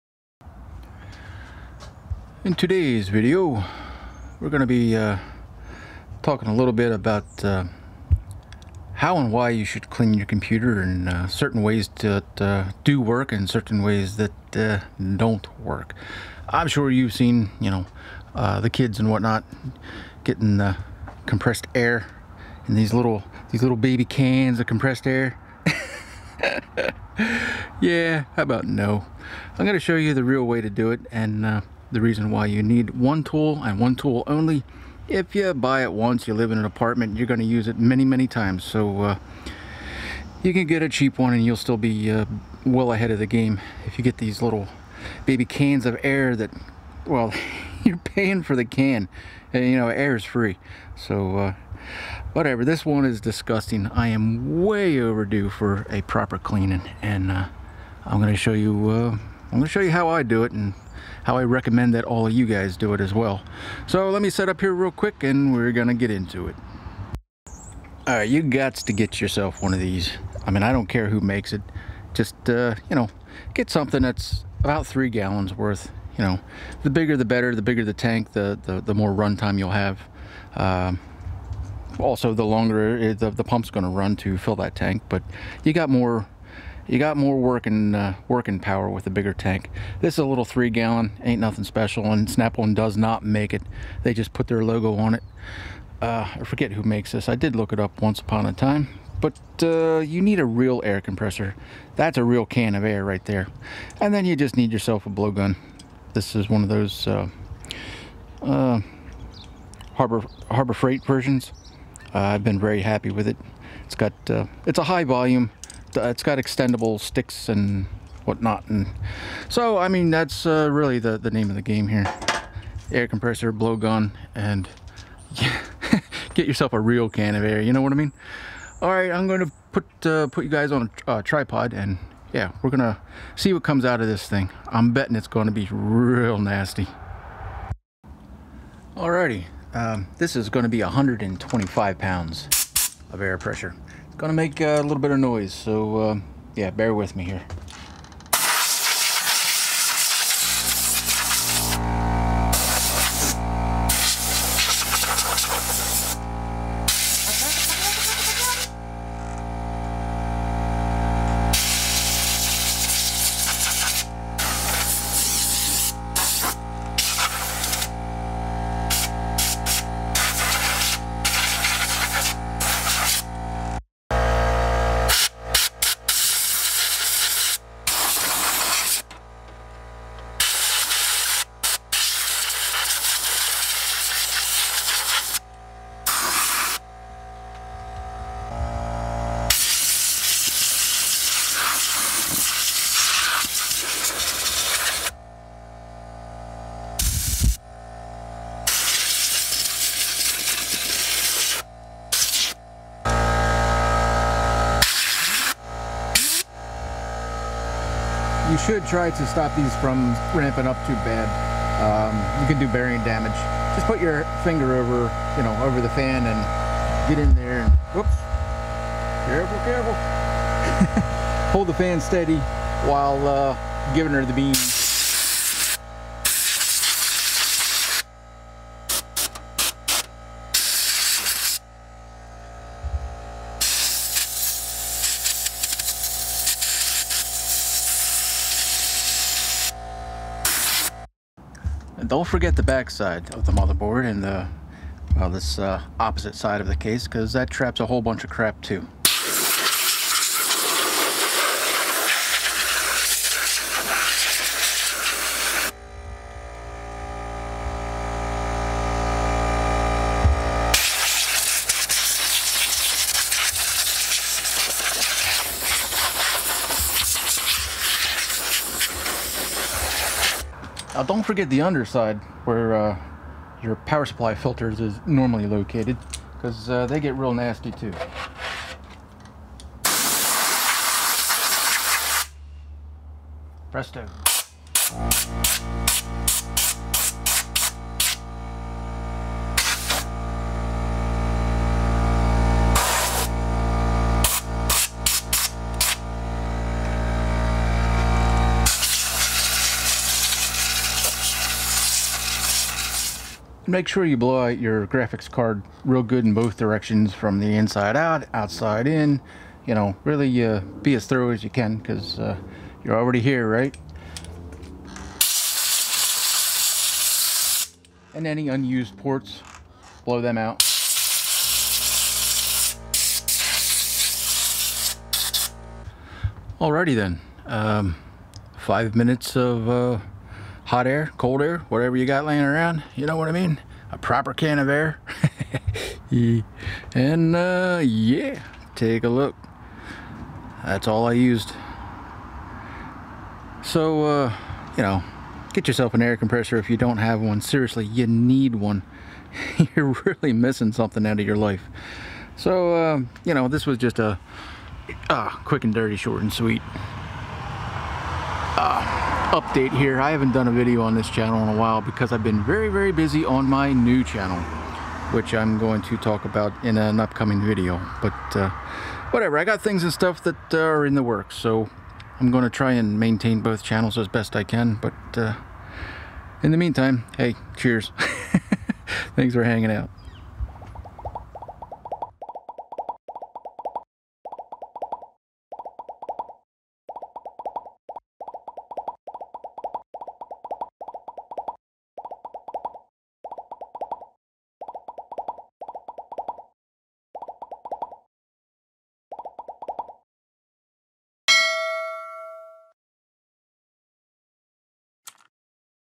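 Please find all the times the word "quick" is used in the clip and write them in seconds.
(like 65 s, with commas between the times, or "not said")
64 s, 355 s.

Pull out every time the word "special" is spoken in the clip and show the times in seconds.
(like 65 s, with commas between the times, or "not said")
91 s.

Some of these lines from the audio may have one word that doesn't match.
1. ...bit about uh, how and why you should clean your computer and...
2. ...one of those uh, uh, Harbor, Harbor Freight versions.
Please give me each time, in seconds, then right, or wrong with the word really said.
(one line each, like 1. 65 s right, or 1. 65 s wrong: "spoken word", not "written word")
1. 6 s right
2. 106 s right.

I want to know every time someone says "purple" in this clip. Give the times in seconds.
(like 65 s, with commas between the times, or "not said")
not said.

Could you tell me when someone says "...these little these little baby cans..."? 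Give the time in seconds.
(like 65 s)
22 s.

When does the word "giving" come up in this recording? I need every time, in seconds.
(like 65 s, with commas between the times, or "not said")
223 s.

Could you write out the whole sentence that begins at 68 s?
Alright, you got to get yourself one of these.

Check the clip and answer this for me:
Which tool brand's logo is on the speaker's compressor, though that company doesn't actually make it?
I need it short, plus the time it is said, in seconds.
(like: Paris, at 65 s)
Snap-on, at 92 s.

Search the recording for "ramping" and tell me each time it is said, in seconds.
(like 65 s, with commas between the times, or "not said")
210 s.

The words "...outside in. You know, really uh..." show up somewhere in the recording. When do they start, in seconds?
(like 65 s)
308 s.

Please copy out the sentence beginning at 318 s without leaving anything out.
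And any unused ports, blow them out.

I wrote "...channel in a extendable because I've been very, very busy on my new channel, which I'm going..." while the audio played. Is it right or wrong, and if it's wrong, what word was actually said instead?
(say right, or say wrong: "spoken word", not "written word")
wrong: "while", not "extendable".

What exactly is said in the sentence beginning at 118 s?
And so, I mean, that's uh, really the, the name of the game here.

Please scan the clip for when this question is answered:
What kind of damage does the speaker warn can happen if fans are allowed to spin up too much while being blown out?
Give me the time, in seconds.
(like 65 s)
212 s.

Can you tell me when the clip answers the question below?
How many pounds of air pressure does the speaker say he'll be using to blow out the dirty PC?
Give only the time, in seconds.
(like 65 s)
140 s.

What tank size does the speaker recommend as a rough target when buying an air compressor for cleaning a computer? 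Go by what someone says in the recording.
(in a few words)
3 gallons.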